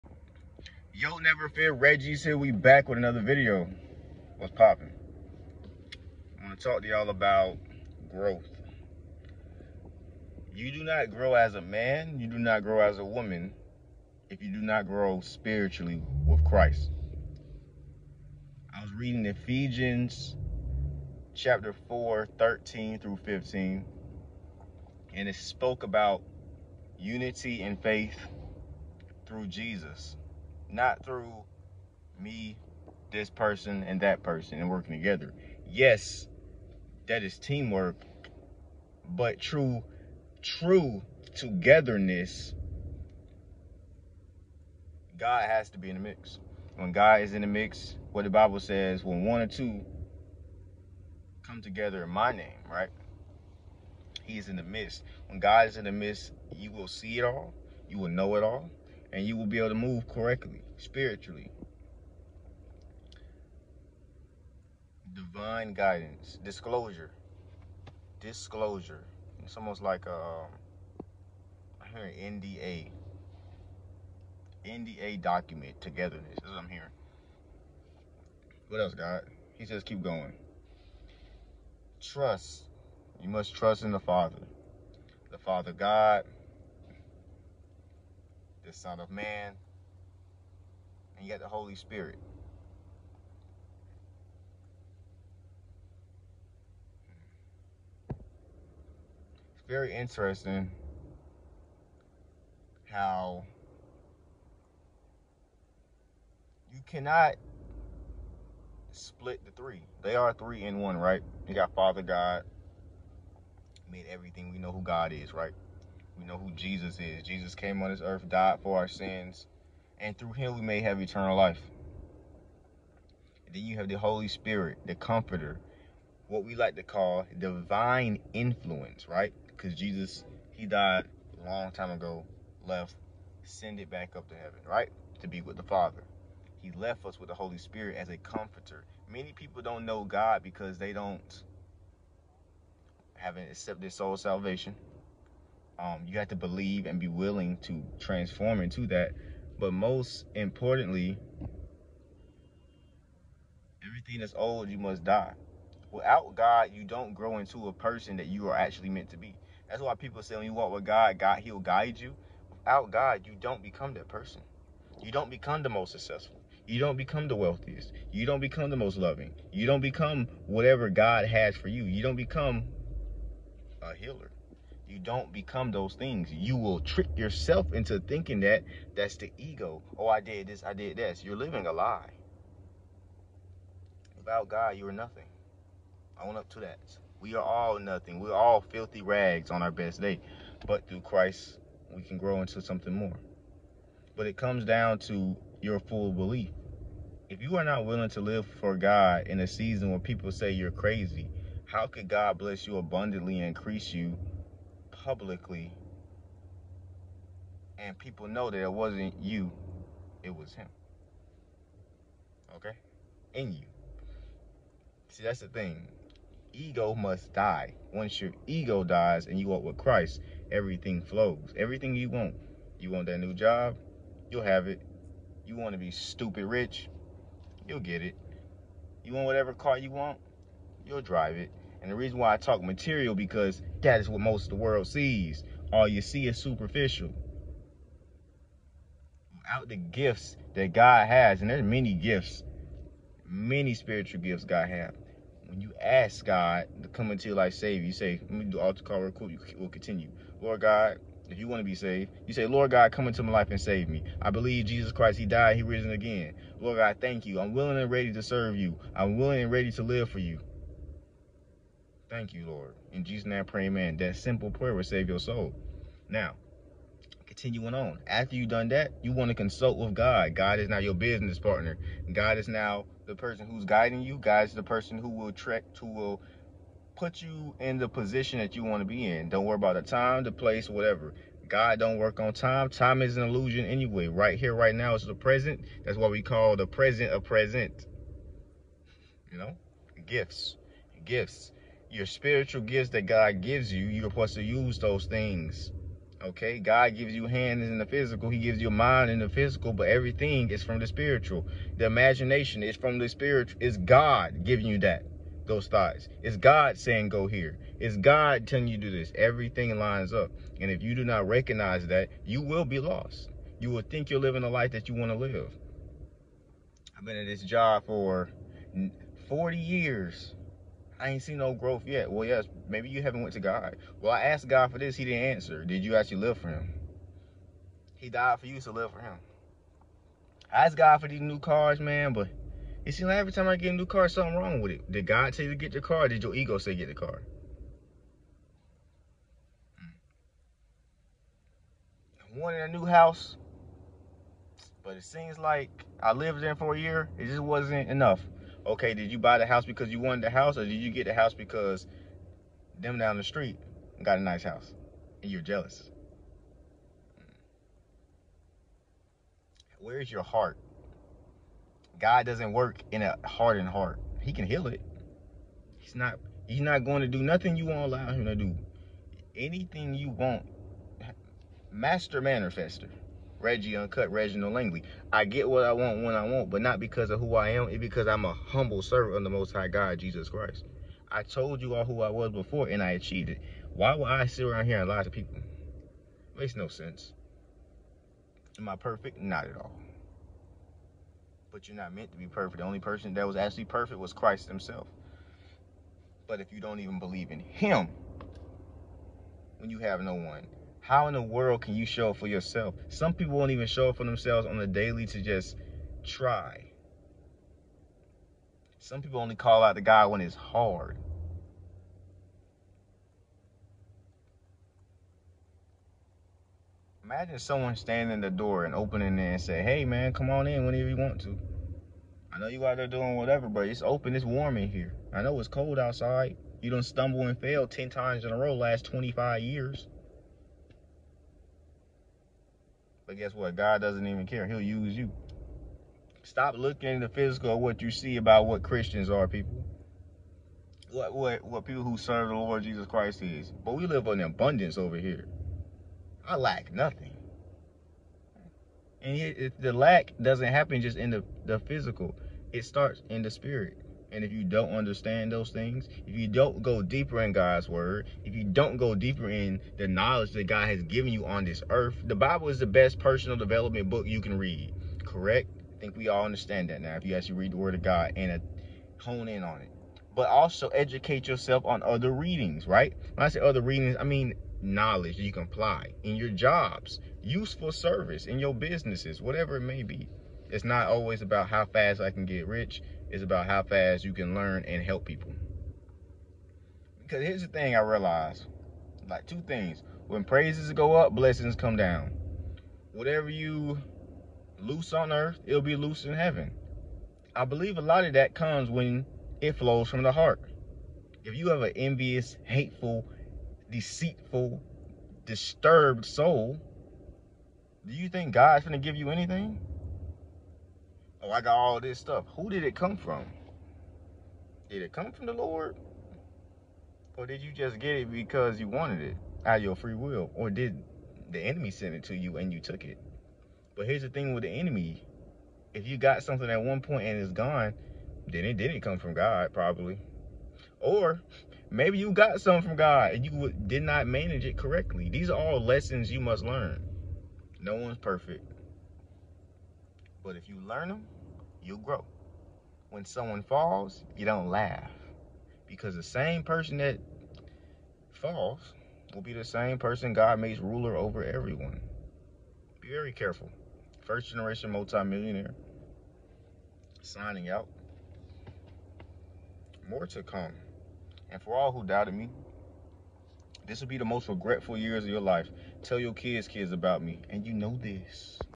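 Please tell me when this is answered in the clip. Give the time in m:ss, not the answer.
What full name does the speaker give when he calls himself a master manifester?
6:14.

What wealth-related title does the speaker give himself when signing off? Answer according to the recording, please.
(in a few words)
First generation multimillionaire.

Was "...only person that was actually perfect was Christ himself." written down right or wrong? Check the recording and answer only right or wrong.
right.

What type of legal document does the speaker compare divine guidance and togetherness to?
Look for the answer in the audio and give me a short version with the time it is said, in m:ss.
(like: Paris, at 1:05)
NDA, at 1:14.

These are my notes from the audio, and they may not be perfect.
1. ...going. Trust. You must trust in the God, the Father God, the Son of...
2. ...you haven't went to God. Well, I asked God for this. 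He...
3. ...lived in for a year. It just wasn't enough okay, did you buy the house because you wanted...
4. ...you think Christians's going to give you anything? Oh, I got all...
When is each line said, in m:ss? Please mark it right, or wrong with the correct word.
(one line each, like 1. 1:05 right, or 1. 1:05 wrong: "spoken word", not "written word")
1. 1:20 wrong: "Father", not "God"
2. 5:22 right
3. 5:46 right
4. 8:27 wrong: "God", not "Christians".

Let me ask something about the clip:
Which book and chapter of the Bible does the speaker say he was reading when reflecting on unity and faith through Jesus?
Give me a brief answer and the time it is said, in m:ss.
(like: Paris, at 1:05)
Ephesians chapter 4, at 0:19.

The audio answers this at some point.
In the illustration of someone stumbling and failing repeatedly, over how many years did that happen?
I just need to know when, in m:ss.
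7:08.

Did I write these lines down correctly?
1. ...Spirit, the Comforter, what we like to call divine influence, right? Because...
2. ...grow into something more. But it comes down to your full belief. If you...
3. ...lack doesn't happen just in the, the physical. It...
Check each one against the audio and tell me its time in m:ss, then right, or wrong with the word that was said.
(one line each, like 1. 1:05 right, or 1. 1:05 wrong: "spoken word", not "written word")
1. 2:04 right
2. 3:12 right
3. 7:29 right.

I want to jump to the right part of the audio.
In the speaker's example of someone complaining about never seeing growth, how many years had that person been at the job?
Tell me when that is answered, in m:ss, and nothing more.
5:19.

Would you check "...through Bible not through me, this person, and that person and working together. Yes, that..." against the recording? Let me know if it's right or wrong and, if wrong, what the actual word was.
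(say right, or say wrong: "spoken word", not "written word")
wrong: "Jesus", not "Bible".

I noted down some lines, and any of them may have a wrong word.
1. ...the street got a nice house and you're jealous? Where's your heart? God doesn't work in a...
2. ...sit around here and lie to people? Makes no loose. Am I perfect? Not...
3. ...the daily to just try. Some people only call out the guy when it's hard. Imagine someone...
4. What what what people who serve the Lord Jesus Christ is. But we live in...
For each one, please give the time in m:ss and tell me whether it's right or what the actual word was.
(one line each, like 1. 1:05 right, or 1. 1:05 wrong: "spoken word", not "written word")
1. 5:53 right
2. 6:24 wrong: "sense", not "loose"
3. 6:44 right
4. 7:20 right.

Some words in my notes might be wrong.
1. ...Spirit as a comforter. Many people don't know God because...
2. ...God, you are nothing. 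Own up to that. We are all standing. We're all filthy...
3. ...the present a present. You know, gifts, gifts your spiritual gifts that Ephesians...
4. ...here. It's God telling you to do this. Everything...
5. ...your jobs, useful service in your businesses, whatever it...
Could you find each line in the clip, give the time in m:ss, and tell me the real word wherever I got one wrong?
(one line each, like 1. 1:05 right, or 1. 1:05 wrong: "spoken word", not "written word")
1. 2:17 right
2. 3:04 wrong: "nothing", not "standing"
3. 4:46 wrong: "God", not "Ephesians"
4. 5:07 right
5. 7:56 right.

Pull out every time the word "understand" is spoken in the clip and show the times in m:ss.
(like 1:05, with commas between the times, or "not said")
7:34, 7:46.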